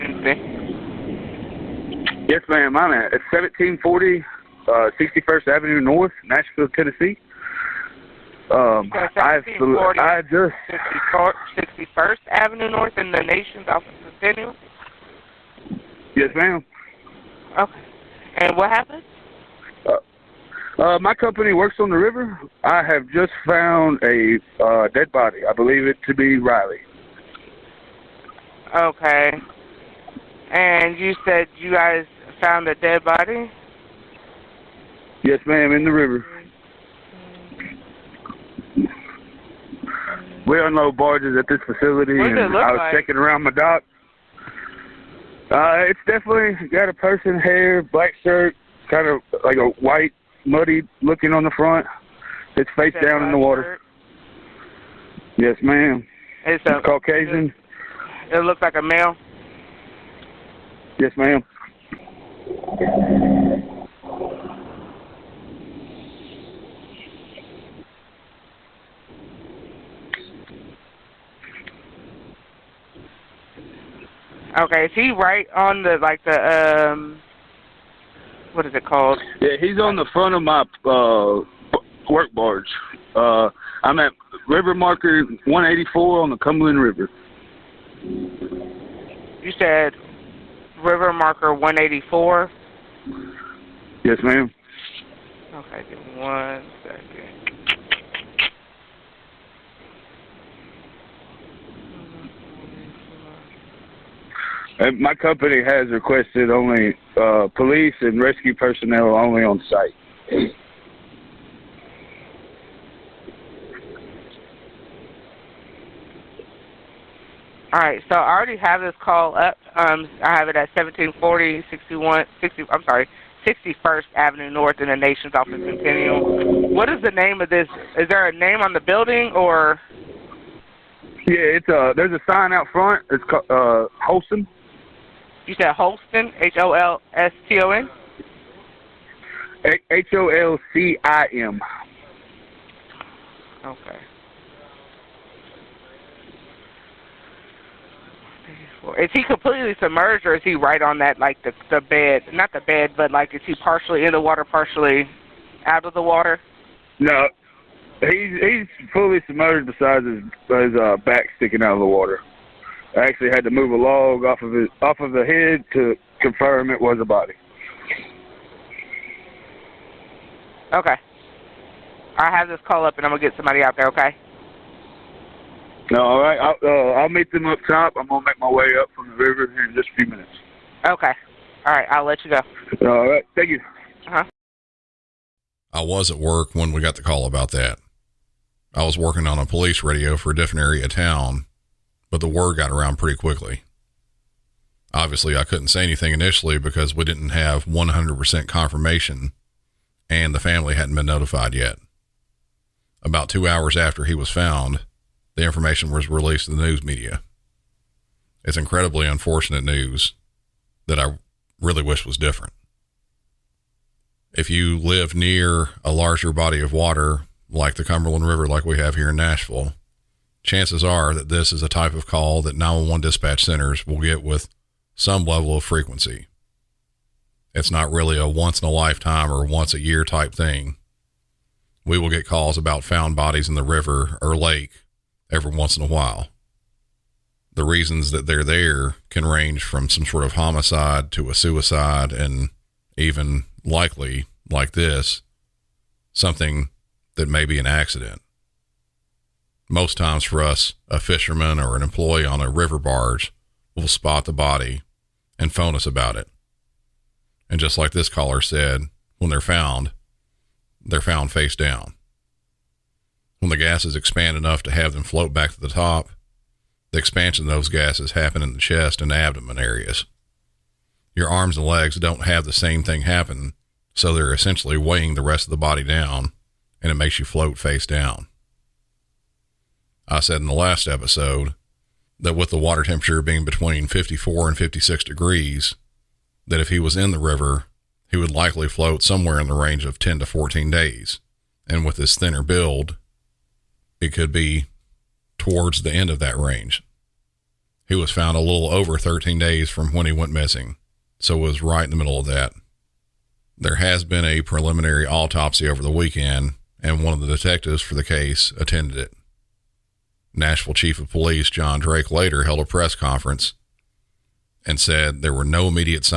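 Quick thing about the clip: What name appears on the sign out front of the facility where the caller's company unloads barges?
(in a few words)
Holcim.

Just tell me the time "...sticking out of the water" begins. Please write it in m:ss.
2:41.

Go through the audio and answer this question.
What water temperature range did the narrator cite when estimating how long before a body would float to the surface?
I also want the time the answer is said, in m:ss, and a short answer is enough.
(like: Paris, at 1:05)
54 to 56 degrees, at 4:43.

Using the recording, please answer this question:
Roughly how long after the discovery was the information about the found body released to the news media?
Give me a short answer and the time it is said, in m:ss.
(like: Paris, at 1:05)
2 hours, at 3:23.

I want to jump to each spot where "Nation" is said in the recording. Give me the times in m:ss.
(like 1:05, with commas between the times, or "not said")
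0:13, 2:04.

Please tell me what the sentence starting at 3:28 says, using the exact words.
It's incredibly unfortunate news that I really wish was different.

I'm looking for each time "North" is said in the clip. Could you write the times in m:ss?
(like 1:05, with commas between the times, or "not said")
0:05, 0:12, 2:04.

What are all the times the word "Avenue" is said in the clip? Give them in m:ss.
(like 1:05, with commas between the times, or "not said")
0:05, 0:12, 2:04.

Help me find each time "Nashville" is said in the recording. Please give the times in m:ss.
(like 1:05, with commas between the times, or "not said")
0:06, 3:39, 5:10.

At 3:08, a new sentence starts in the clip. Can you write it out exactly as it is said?
I was working on a police radio for a different area of town but the word got around pretty quickly.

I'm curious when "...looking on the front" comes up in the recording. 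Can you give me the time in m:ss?
0:51.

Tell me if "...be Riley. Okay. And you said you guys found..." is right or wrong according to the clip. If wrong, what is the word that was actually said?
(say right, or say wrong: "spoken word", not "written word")
right.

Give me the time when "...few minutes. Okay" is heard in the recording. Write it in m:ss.
2:59.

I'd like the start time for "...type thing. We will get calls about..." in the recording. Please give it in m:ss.
3:50.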